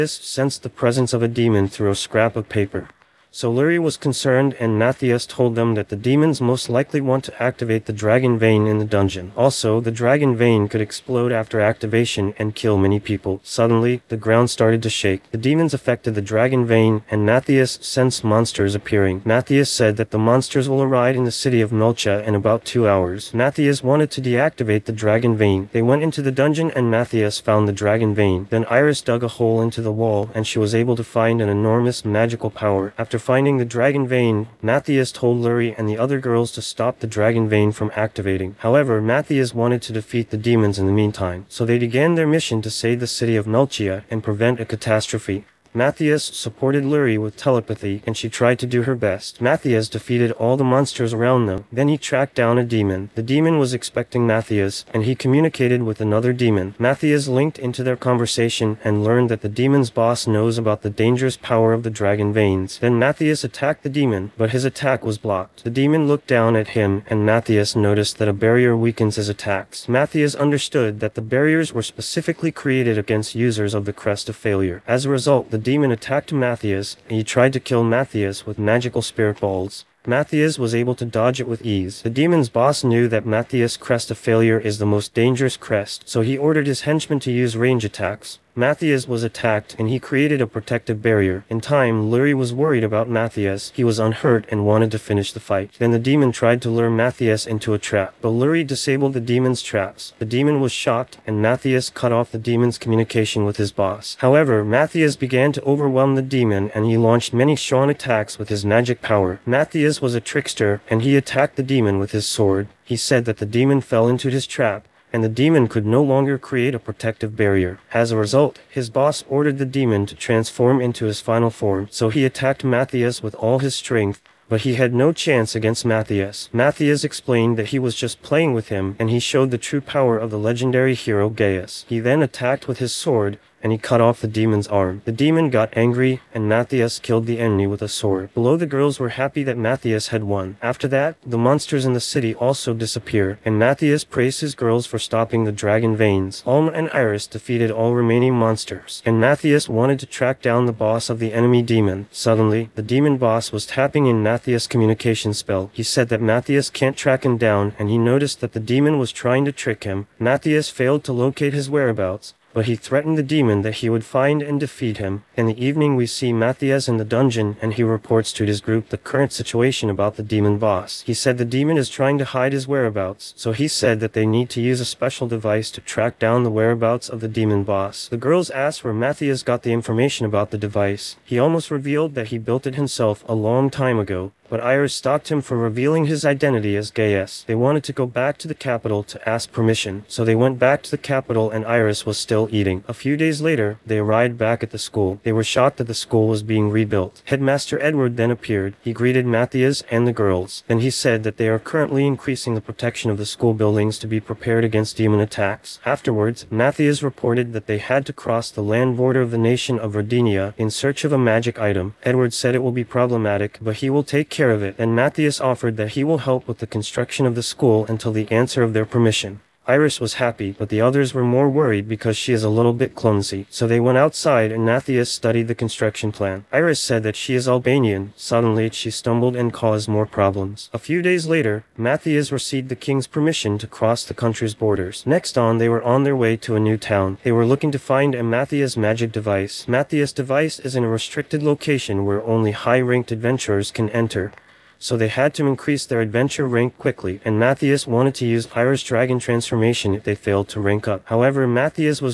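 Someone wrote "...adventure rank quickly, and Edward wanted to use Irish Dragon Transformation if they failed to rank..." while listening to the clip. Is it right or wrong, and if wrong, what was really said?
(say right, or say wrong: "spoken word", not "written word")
wrong: "Matthias", not "Edward".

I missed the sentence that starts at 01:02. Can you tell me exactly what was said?
Then Matthias attacked the demon, but his attack was blocked.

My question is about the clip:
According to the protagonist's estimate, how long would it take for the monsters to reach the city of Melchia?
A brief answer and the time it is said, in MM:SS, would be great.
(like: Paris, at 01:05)
2 hours, at 00:22.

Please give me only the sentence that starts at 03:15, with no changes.
They were shocked that the school was being rebuilt.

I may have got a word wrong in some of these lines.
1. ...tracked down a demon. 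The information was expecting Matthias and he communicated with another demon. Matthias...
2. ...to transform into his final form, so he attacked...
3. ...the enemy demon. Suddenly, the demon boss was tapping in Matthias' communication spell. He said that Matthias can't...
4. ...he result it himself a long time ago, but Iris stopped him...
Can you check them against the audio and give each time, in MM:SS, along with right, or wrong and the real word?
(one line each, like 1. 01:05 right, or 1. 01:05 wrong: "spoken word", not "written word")
1. 00:51 wrong: "demon", not "information"
2. 02:00 right
3. 02:31 right
4. 03:02 wrong: "built", not "result".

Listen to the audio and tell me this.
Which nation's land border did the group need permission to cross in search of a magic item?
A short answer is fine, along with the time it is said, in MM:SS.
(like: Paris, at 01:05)
Rodinia, at 03:29.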